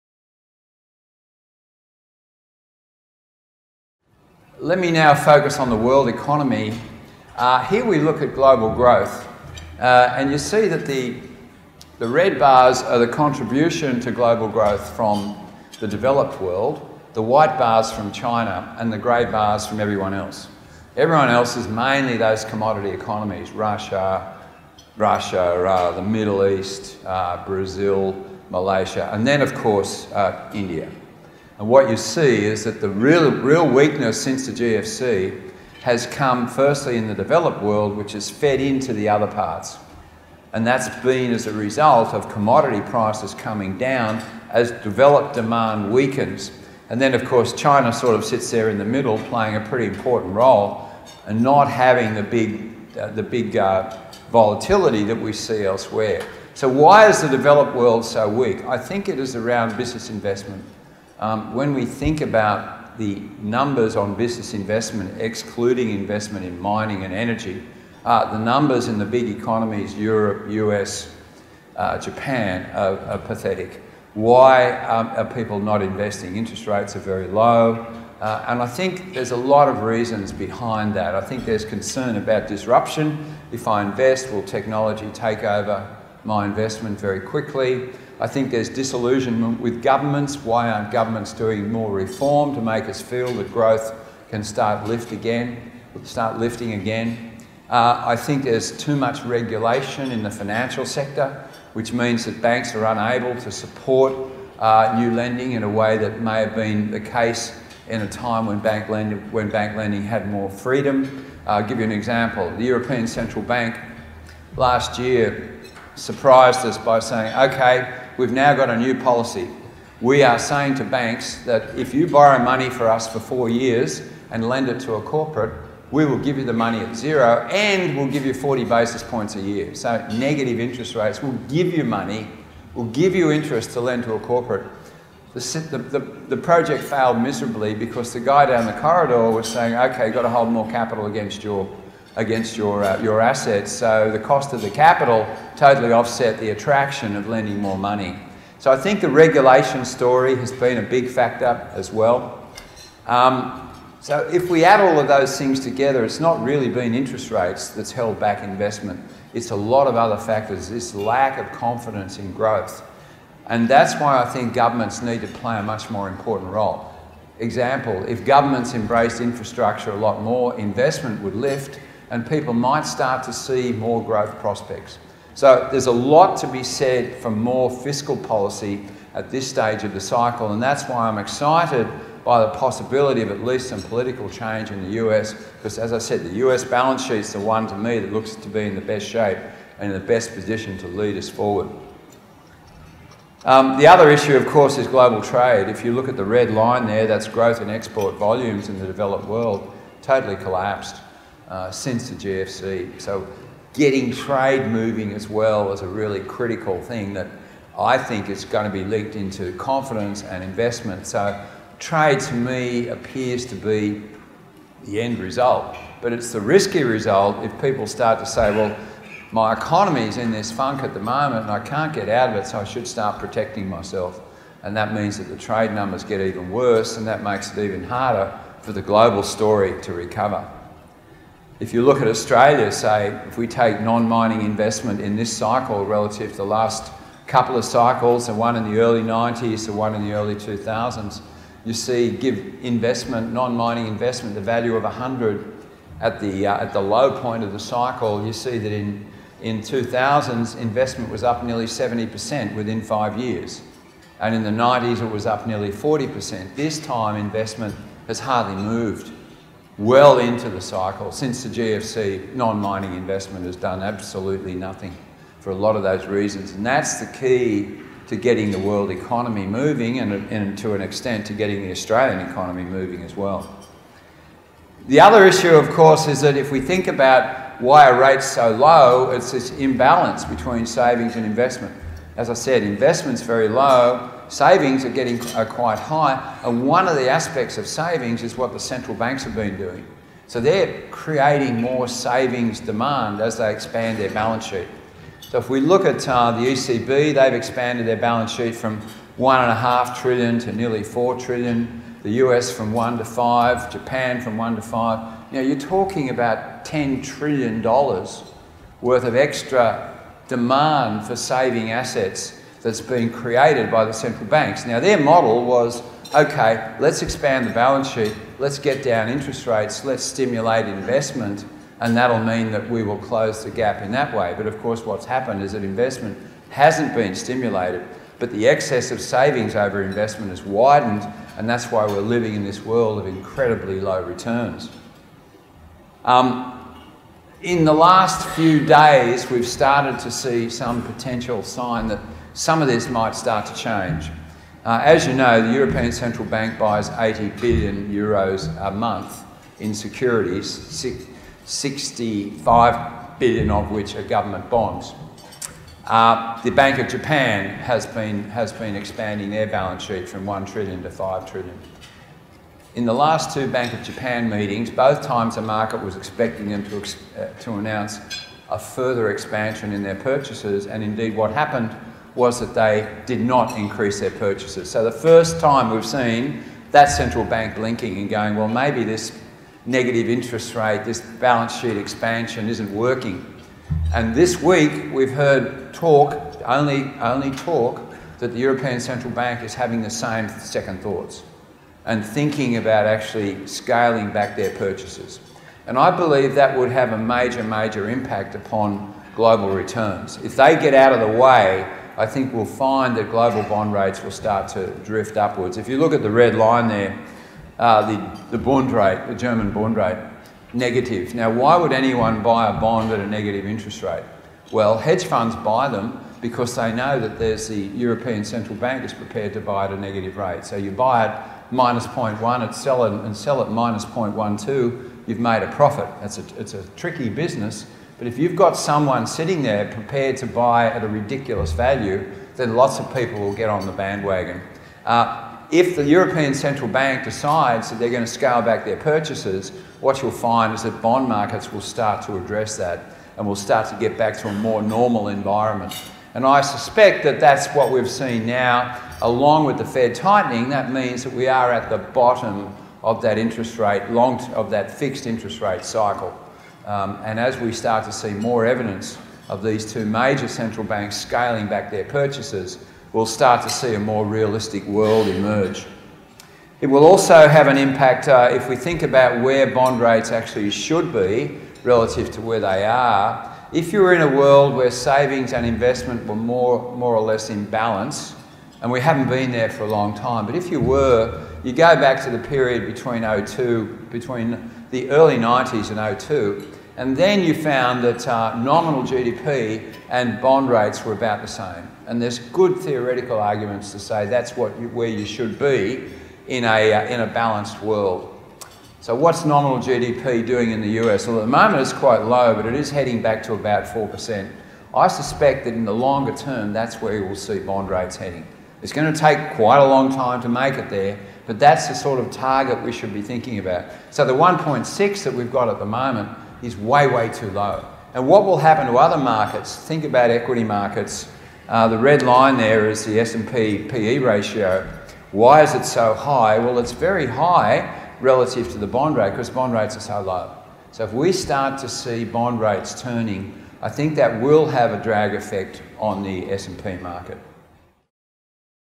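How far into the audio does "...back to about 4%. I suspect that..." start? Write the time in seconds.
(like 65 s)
503 s.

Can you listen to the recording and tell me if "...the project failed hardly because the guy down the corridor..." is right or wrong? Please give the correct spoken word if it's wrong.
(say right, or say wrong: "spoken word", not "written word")
wrong: "miserably", not "hardly".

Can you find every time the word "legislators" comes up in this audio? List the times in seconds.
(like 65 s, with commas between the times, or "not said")
not said.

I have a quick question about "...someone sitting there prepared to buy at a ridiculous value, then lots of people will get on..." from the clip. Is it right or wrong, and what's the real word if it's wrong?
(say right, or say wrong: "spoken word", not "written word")
right.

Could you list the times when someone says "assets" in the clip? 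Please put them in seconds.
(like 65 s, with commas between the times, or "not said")
143 s, 311 s.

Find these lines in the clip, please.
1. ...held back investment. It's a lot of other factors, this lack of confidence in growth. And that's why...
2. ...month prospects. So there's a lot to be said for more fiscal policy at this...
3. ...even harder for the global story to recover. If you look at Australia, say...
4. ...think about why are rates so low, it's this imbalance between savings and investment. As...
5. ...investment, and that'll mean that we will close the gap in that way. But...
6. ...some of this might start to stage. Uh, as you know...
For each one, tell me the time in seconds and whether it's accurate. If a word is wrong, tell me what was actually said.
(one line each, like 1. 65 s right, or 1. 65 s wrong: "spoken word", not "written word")
1. 157 s right
2. 174 s wrong: "growth", not "month"
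3. 227 s right
4. 276 s right
5. 320 s right
6. 342 s wrong: "change", not "stage".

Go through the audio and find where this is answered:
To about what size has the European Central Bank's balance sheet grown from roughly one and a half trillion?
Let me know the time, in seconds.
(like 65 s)
300 s.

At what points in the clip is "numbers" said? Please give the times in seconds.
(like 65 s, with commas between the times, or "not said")
63 s, 68 s, 225 s.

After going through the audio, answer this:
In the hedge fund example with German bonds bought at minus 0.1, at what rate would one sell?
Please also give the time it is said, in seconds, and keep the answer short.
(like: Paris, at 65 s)
-0.12, at 423 s.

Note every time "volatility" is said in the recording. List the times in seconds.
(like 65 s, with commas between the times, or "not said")
54 s.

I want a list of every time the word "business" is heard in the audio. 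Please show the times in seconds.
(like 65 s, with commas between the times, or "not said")
59 s, 64 s, 427 s.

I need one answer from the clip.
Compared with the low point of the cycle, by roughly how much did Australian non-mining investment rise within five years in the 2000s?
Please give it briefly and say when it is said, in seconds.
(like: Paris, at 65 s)
Nearly 70%, at 251 s.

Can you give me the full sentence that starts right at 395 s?
And I believe that would have a major, major impact upon global returns.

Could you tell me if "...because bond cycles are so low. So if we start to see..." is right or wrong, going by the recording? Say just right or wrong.
wrong.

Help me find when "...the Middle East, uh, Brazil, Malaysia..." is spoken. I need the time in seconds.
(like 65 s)
25 s.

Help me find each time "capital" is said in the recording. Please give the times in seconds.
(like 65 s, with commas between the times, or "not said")
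140 s, 144 s.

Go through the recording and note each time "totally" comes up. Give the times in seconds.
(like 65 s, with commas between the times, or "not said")
145 s, 200 s.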